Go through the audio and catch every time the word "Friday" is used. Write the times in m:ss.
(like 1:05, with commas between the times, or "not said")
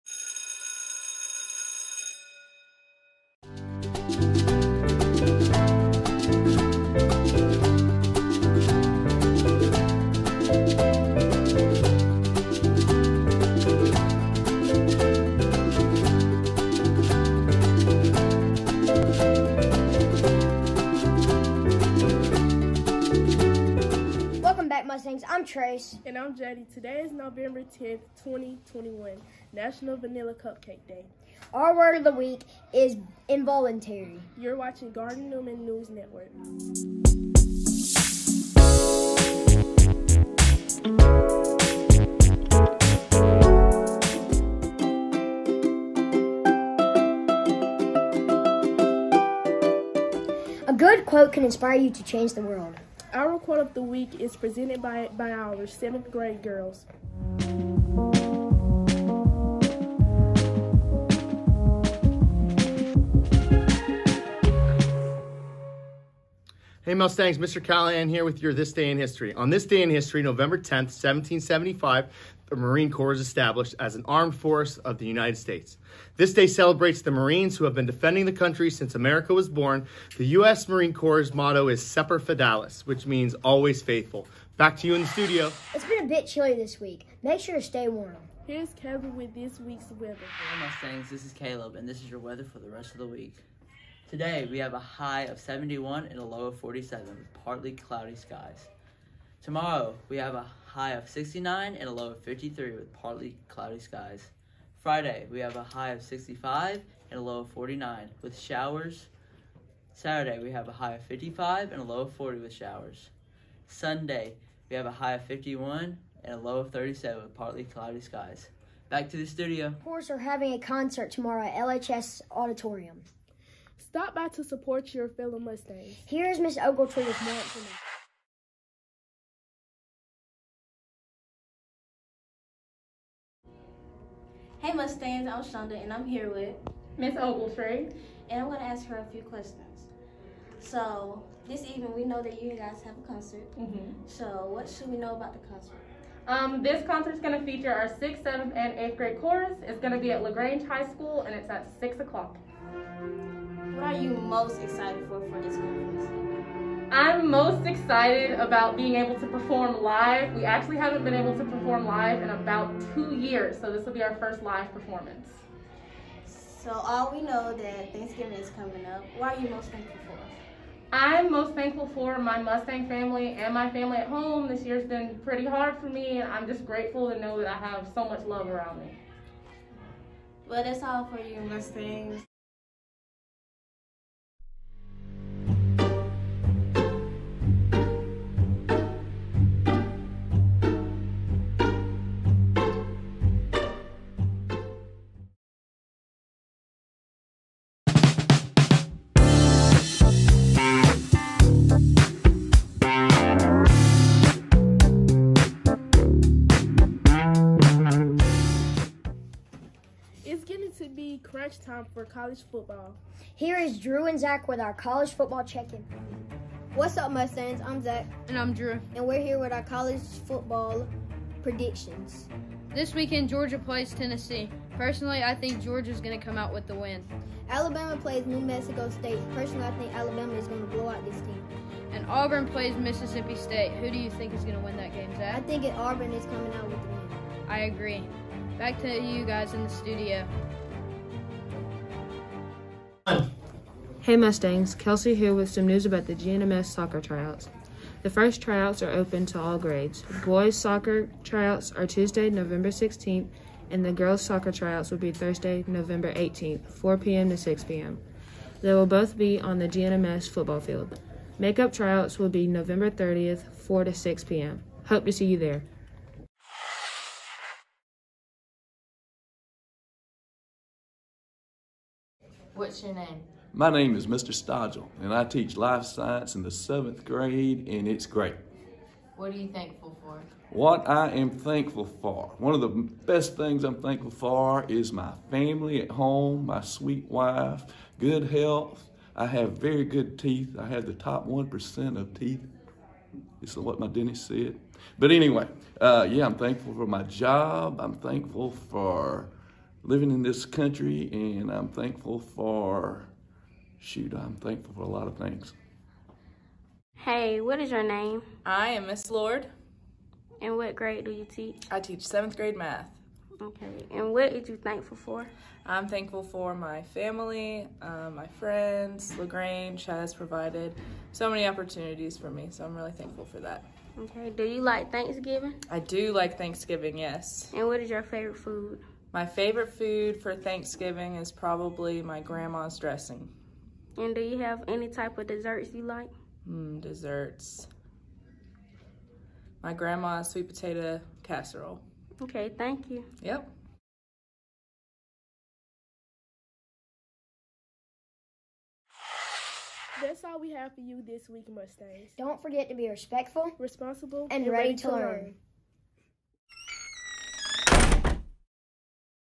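1:44.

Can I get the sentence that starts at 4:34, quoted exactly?
Stodgel, and I teach life science in the seventh grade, and it's great.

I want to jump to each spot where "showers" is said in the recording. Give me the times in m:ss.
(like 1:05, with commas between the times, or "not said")
1:48, 1:52.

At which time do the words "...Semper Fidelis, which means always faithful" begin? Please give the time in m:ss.
1:21.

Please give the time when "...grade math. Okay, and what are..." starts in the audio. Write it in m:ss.
5:12.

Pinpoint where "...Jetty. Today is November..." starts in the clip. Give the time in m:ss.
0:26.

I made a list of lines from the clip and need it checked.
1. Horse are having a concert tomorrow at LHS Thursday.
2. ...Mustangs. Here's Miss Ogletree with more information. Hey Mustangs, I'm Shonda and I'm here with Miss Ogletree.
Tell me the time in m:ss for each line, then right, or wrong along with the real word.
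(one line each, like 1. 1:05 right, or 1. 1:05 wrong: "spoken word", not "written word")
1. 1:59 wrong: "Auditorium", not "Thursday"
2. 2:05 right.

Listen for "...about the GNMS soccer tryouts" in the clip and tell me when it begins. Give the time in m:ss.
4:05.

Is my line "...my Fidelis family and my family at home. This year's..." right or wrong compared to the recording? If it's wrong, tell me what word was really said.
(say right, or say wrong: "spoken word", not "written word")
wrong: "Mustang", not "Fidelis".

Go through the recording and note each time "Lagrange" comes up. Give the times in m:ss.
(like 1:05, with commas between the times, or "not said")
2:30, 5:19.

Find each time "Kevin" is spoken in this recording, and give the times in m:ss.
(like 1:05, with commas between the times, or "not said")
1:28.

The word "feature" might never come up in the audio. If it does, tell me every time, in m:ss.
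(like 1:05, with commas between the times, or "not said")
2:27.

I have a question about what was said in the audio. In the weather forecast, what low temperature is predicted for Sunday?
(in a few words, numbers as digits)
37.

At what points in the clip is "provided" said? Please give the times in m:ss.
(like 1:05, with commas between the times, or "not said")
5:20.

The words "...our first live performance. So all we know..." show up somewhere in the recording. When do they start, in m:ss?
2:44.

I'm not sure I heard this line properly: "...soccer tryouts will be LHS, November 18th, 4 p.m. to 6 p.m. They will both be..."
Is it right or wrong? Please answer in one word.
wrong.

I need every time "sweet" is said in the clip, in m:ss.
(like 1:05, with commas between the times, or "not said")
4:46, 5:40.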